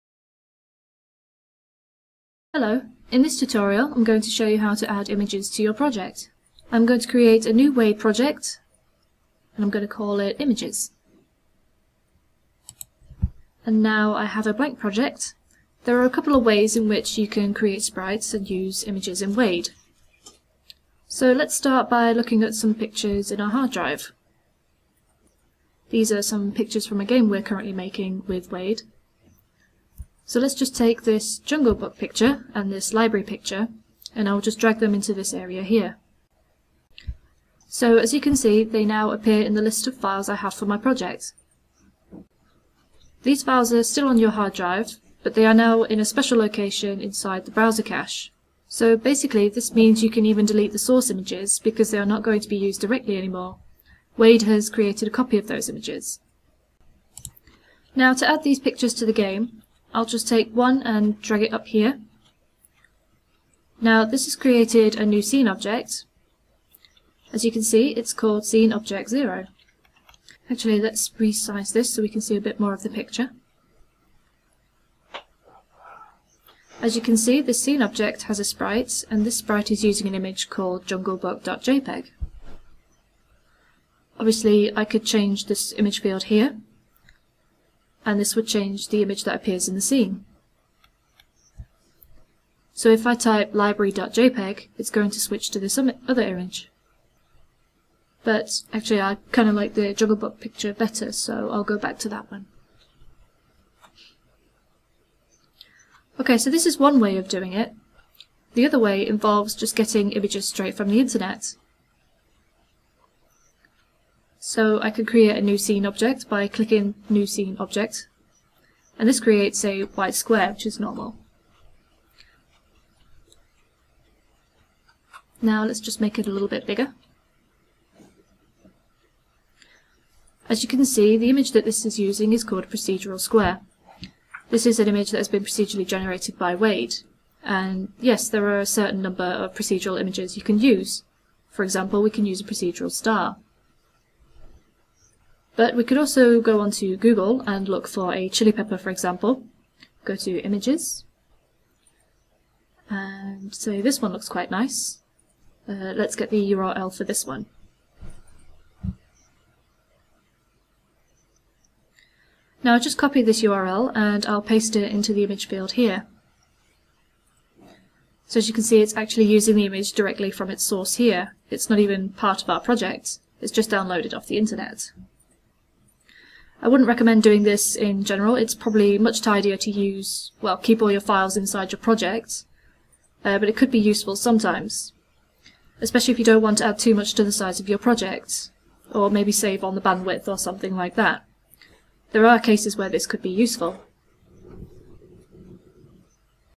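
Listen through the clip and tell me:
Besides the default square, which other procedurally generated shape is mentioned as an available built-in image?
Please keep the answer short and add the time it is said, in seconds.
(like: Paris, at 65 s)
procedural star, at 142 s.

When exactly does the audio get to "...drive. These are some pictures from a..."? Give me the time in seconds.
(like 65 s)
23 s.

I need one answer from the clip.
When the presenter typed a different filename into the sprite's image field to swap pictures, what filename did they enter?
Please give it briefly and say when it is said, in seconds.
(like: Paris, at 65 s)
library.jpg, at 93 s.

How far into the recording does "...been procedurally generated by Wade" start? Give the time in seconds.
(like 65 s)
135 s.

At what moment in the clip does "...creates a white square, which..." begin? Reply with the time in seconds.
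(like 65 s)
119 s.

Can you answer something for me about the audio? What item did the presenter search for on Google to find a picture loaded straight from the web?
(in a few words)
chili pepper.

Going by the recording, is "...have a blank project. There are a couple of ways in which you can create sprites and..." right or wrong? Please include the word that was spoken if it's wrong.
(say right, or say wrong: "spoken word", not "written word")
right.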